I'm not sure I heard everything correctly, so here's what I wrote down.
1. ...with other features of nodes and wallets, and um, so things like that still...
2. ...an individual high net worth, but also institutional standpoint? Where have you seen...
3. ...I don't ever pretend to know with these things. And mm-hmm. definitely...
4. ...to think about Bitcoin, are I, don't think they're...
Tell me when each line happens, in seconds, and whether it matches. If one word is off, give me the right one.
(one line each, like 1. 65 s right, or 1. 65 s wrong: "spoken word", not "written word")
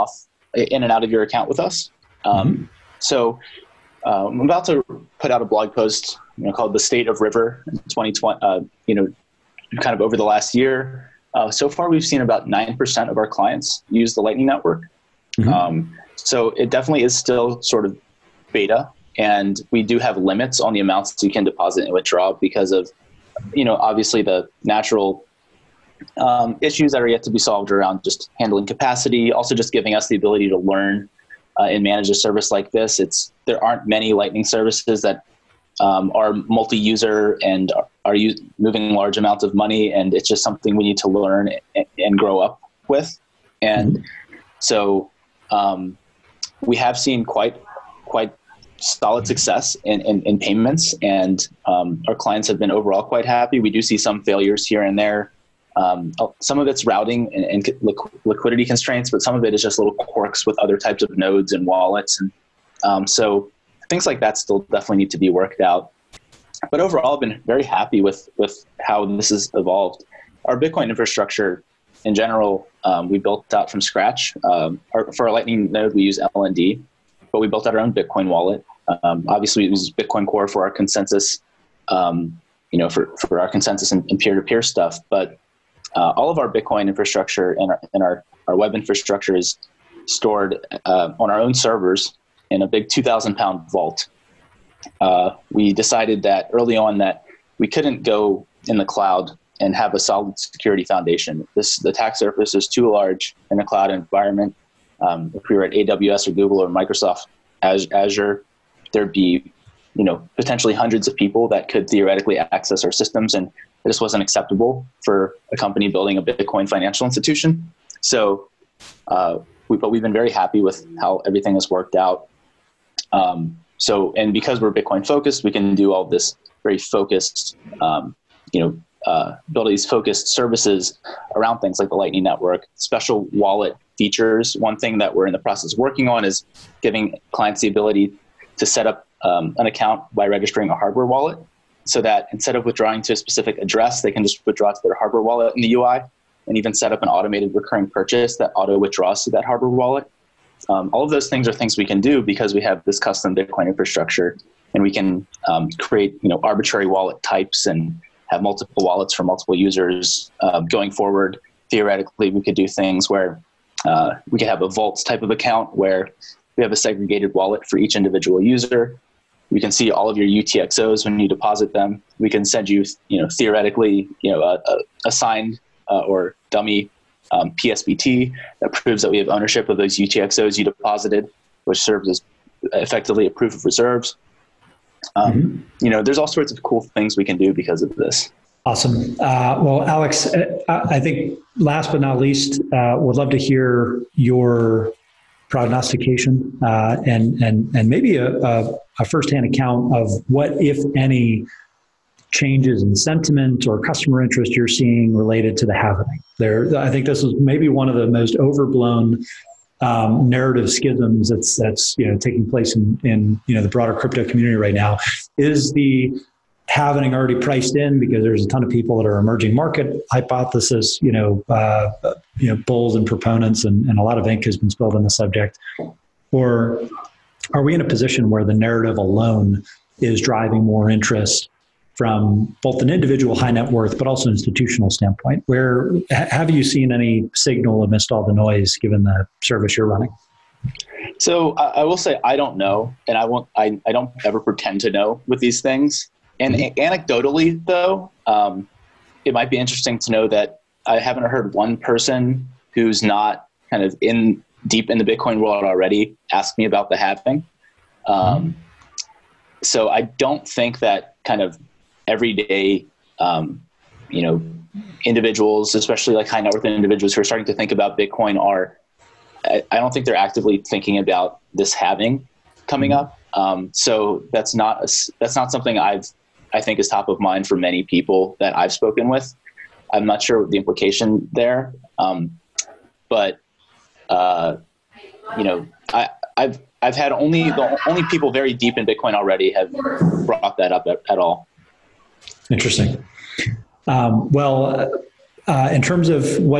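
1. 60 s wrong: "types", not "features"
2. 232 s right
3. 243 s wrong: "anecdotally", not "definitely"
4. 267 s right.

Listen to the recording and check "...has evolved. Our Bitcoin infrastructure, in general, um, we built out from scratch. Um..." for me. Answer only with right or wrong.
right.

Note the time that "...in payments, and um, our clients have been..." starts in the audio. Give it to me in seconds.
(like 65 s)
50 s.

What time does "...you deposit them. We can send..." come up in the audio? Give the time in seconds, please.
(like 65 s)
171 s.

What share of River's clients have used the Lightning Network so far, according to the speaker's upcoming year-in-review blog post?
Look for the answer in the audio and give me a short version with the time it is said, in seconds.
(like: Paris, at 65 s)
9%, at 12 s.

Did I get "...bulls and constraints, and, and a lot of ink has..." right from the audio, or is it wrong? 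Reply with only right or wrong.
wrong.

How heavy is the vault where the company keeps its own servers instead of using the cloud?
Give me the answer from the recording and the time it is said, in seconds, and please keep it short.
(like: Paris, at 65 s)
2,000 pounds, at 92 s.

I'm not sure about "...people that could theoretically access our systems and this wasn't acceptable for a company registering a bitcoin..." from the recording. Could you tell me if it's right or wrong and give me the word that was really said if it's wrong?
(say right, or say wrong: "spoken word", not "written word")
wrong: "building", not "registering".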